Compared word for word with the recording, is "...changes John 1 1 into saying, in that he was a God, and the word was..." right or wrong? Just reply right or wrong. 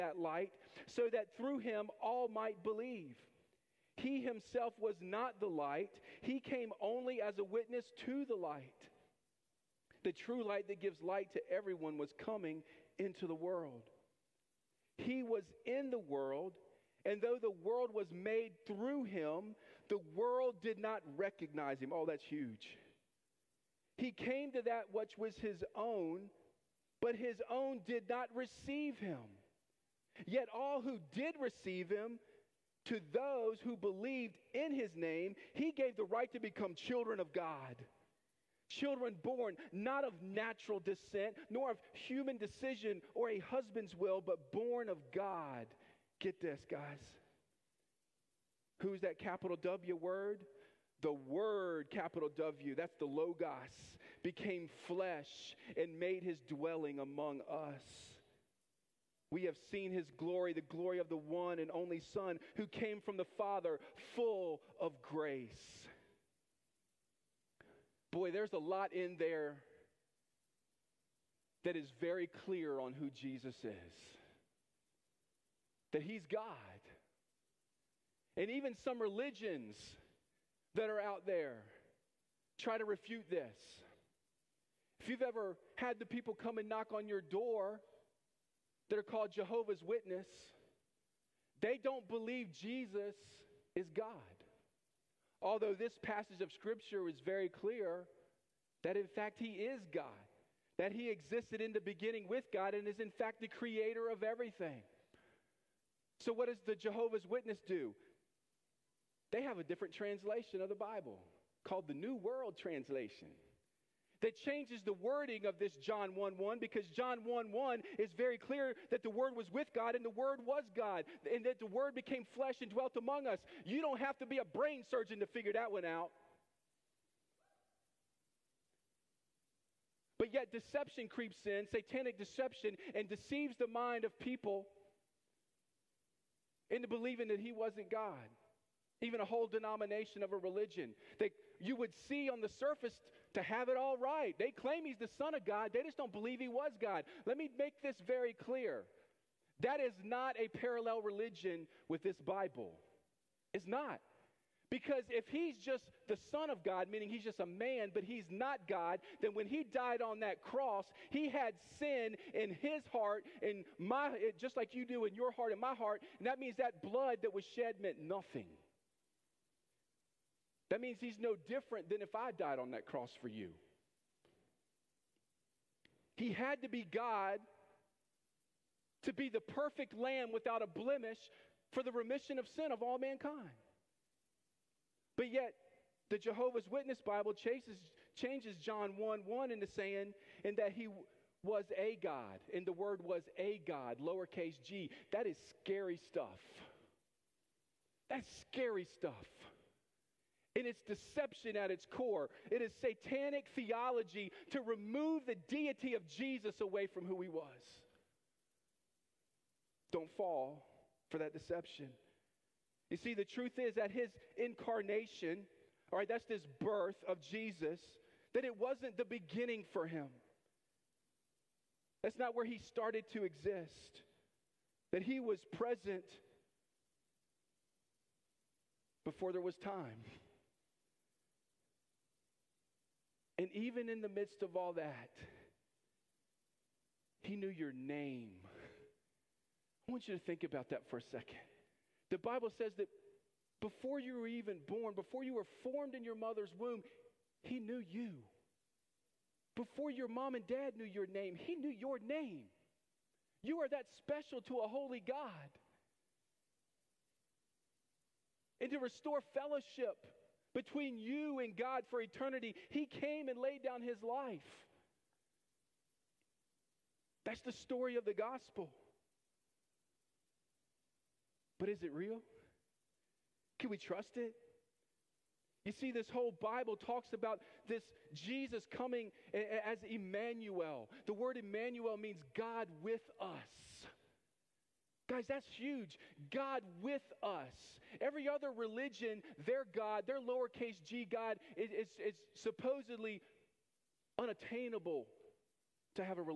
right.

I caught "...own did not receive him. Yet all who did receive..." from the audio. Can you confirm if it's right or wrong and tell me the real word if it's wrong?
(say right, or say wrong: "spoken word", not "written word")
right.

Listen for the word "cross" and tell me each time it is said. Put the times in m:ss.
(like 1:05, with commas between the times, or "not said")
2:40, 2:52.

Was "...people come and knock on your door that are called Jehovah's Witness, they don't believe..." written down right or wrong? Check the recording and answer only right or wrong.
right.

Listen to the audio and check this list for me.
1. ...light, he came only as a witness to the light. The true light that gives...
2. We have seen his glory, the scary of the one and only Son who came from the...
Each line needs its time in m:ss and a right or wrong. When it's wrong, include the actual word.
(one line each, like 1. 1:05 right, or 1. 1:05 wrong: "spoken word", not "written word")
1. 0:05 right
2. 0:59 wrong: "glory", not "scary".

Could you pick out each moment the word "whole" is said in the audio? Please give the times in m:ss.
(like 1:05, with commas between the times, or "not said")
2:19, 4:36.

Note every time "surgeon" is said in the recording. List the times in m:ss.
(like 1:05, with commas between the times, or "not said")
2:04.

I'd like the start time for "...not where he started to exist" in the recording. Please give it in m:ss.
3:42.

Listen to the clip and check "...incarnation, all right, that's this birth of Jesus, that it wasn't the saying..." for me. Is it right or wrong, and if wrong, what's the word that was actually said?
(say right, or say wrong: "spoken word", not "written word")
wrong: "beginning", not "saying".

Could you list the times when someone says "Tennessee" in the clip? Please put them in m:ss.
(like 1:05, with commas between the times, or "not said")
not said.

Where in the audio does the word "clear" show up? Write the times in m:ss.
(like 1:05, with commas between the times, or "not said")
1:12, 1:37, 1:58, 2:28.